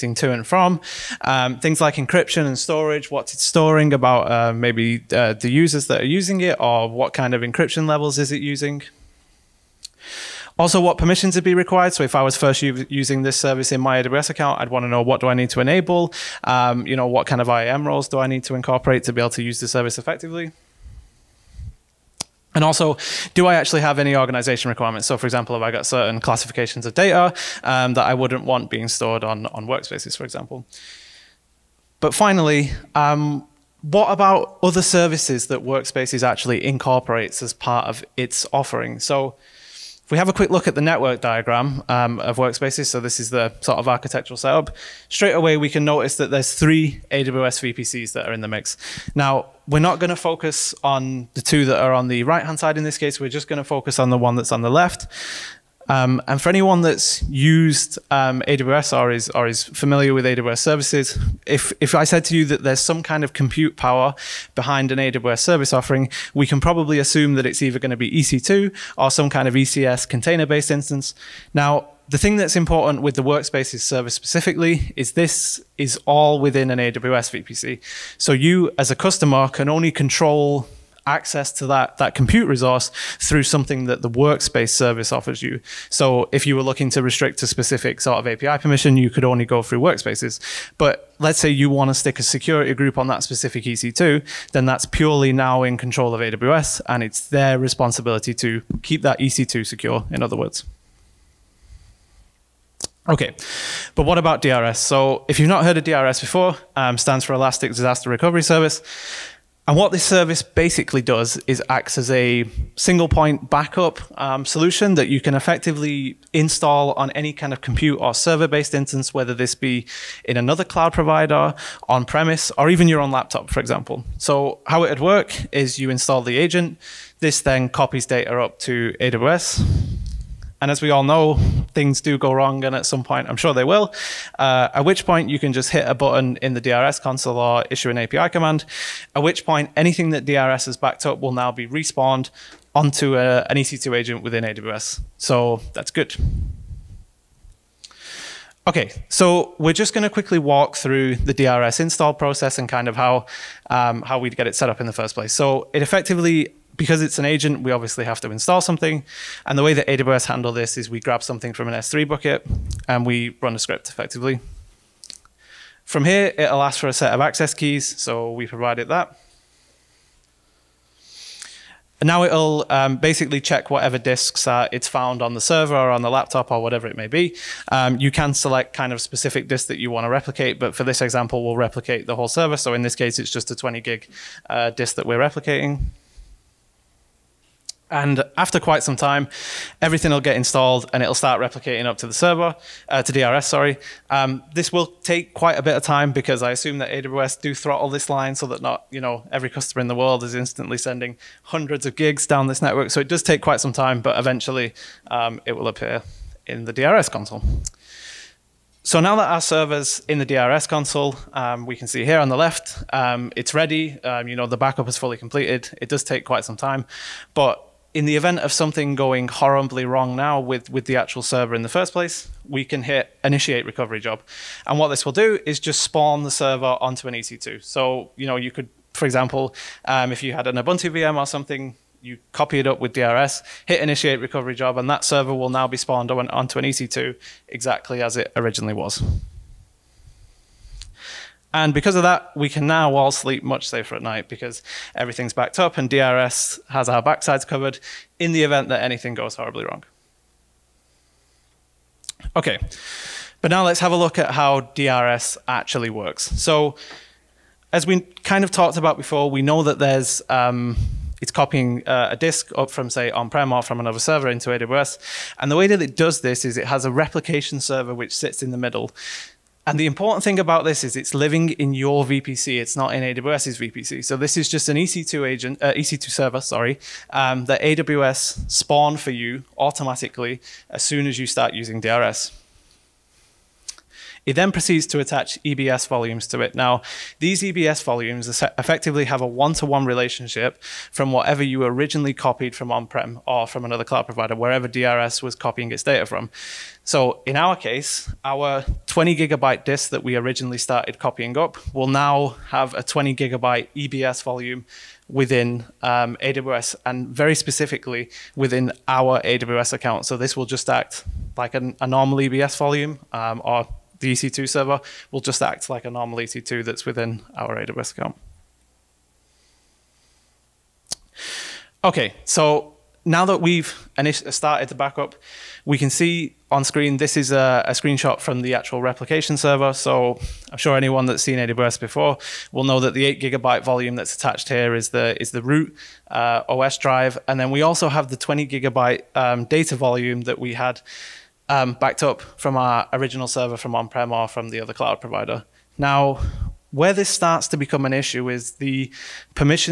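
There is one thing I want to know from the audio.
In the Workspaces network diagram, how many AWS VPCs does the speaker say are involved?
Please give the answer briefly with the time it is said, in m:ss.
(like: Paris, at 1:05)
3, at 0:46.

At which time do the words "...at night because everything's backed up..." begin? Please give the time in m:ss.
4:03.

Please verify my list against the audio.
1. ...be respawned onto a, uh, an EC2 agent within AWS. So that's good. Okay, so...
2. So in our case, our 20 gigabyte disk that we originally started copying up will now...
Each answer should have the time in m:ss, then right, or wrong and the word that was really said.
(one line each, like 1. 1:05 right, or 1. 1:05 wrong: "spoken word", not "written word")
1. 2:21 right
2. 4:56 right.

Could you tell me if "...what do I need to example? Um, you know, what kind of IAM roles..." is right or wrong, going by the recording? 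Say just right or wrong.
wrong.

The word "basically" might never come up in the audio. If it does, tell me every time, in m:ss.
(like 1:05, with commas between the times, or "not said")
1:50, 2:52.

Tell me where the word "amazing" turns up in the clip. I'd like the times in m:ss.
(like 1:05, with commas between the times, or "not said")
not said.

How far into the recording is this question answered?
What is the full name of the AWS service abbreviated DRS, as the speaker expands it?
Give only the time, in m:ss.
1:47.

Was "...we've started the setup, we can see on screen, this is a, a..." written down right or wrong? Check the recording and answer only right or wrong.
wrong.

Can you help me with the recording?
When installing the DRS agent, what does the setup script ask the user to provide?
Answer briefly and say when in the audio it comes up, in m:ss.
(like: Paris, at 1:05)
Access keys, at 2:47.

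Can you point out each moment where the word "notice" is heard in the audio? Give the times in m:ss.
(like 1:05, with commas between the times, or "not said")
0:45.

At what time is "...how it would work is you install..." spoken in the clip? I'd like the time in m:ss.
2:04.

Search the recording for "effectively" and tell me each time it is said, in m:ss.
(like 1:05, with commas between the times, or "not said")
0:19, 1:55, 2:35, 2:43, 4:48.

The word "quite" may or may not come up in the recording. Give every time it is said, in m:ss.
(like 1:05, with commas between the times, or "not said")
3:08, 3:15, 3:23, 3:36.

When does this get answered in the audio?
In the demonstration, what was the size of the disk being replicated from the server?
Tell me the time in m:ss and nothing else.
3:03.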